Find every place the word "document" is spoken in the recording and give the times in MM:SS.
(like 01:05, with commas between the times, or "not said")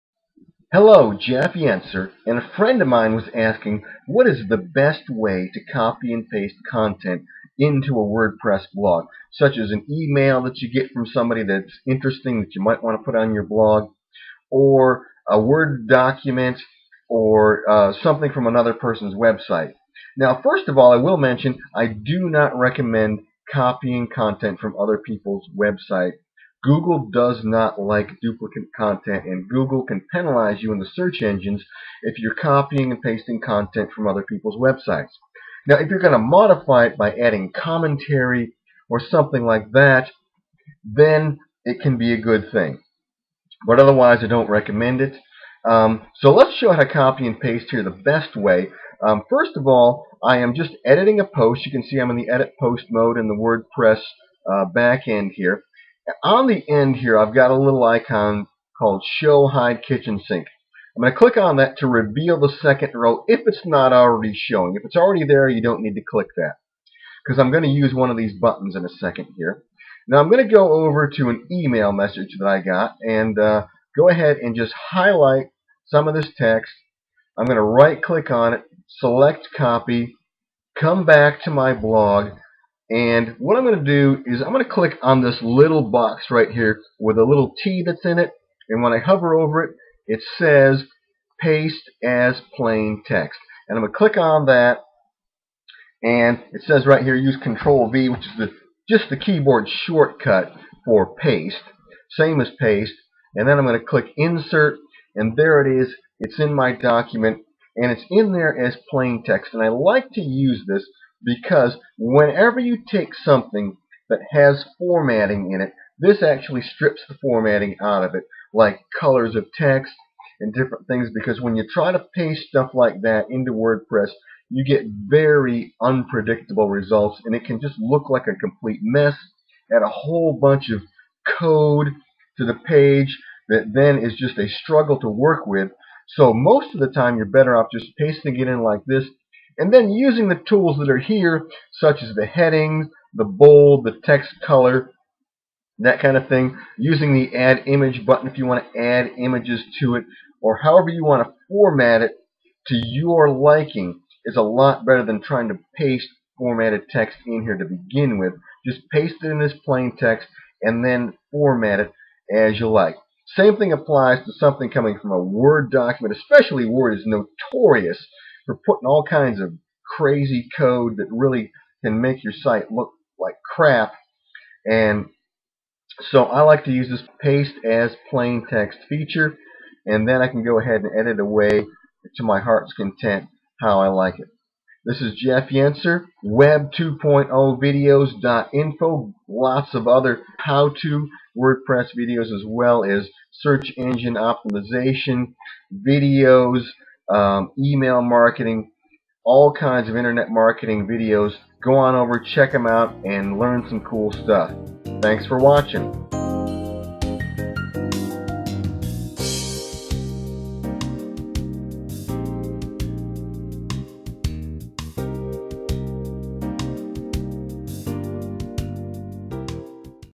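00:15, 01:46, 02:45.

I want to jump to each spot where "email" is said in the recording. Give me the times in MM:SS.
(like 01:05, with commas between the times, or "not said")
00:09, 01:11, 03:17.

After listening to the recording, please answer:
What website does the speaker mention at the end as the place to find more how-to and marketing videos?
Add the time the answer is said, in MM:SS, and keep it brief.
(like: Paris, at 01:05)
web2.0videos.info, at 03:06.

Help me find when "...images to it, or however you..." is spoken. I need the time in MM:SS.
02:29.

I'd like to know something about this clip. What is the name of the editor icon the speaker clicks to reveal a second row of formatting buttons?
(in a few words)
Show Hide Kitchen Sink.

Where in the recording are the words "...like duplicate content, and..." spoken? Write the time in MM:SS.
00:27.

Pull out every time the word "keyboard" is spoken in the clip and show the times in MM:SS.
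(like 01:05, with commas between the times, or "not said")
01:39.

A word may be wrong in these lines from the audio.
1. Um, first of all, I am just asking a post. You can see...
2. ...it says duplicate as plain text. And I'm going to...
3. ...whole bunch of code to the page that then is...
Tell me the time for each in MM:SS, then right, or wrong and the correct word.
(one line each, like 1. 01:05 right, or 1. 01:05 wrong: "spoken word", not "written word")
1. 00:49 wrong: "editing", not "asking"
2. 01:30 wrong: "paste", not "duplicate"
3. 02:09 right.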